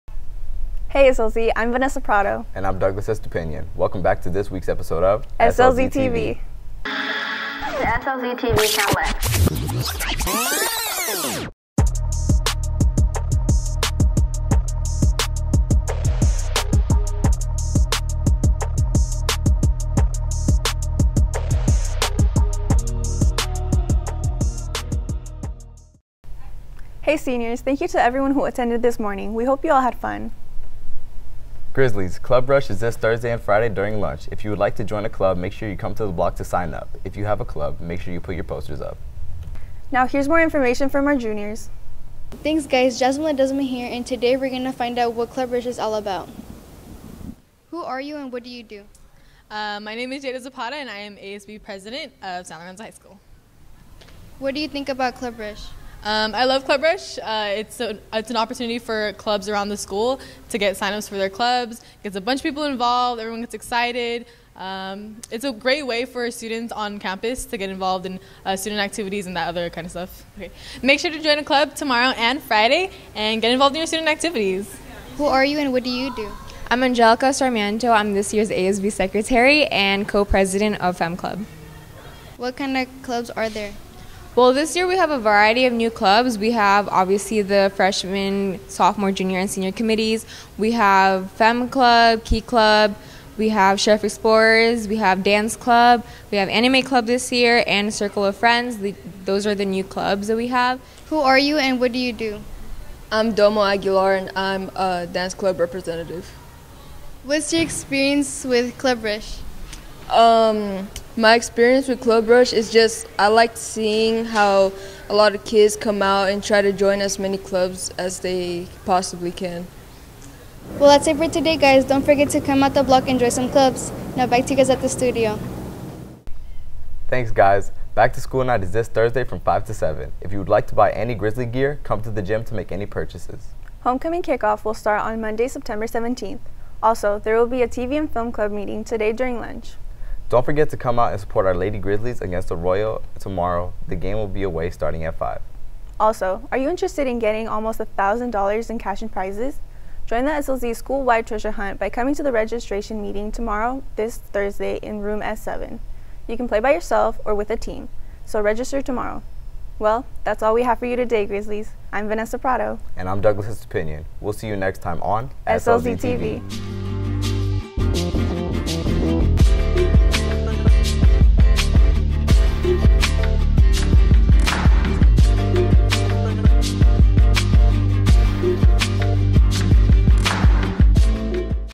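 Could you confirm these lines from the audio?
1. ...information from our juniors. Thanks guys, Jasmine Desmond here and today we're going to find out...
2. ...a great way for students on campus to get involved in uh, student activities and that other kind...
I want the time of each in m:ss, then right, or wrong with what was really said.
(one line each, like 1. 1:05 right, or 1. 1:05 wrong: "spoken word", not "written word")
1. 0:40 right
2. 1:05 right.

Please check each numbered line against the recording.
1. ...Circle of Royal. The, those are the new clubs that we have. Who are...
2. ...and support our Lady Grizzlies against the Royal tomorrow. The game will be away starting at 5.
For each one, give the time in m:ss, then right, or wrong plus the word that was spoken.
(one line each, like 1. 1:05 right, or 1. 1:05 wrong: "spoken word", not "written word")
1. 1:37 wrong: "Friends", not "Royal"
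2. 2:21 right.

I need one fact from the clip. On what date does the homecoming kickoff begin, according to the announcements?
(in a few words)
September 17th.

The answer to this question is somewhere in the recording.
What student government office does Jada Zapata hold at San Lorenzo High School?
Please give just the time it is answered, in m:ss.
0:51.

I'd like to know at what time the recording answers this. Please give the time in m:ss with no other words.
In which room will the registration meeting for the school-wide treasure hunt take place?
2:35.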